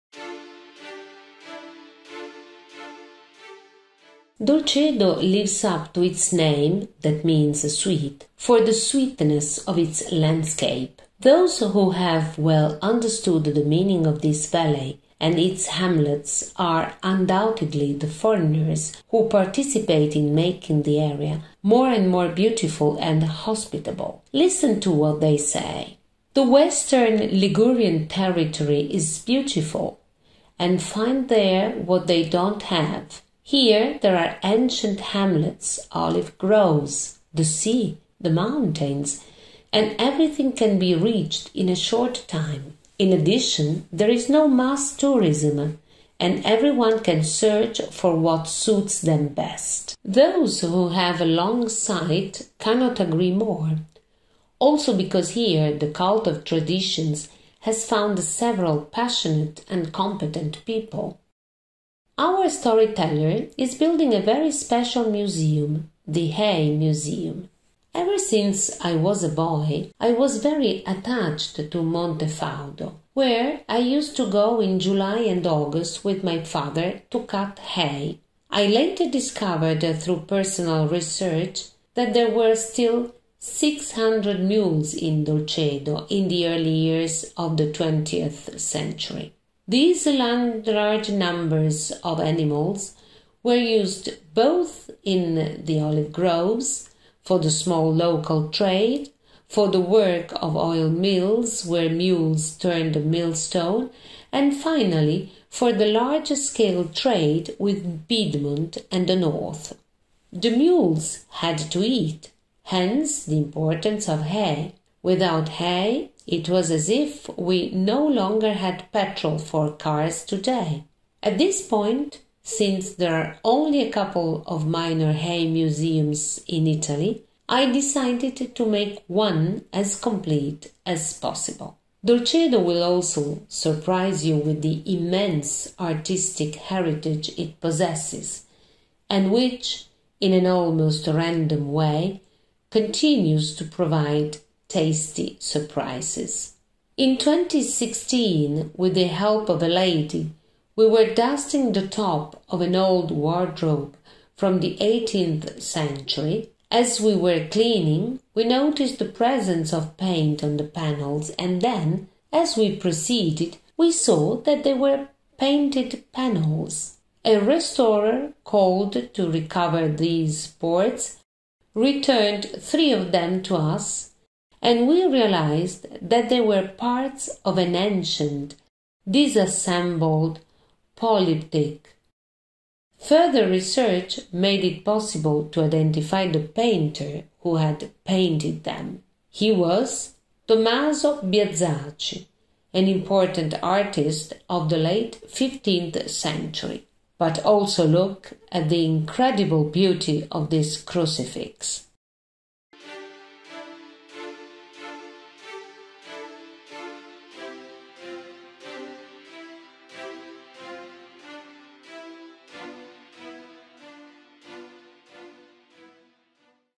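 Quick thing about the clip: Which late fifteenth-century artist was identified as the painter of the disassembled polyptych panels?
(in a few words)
Tommaso Biazaci.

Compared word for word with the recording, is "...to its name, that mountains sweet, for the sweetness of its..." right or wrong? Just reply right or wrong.
wrong.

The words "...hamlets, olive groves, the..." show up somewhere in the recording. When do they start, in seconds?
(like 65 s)
34 s.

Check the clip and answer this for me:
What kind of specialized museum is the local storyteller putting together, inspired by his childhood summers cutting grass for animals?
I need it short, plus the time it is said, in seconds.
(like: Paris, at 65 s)
Hay Museum, at 66 s.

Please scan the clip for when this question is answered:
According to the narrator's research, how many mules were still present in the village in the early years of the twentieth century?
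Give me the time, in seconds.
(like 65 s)
83 s.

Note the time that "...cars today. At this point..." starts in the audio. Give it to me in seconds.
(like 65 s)
119 s.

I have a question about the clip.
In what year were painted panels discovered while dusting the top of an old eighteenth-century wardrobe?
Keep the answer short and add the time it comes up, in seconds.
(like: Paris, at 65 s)
2016, at 146 s.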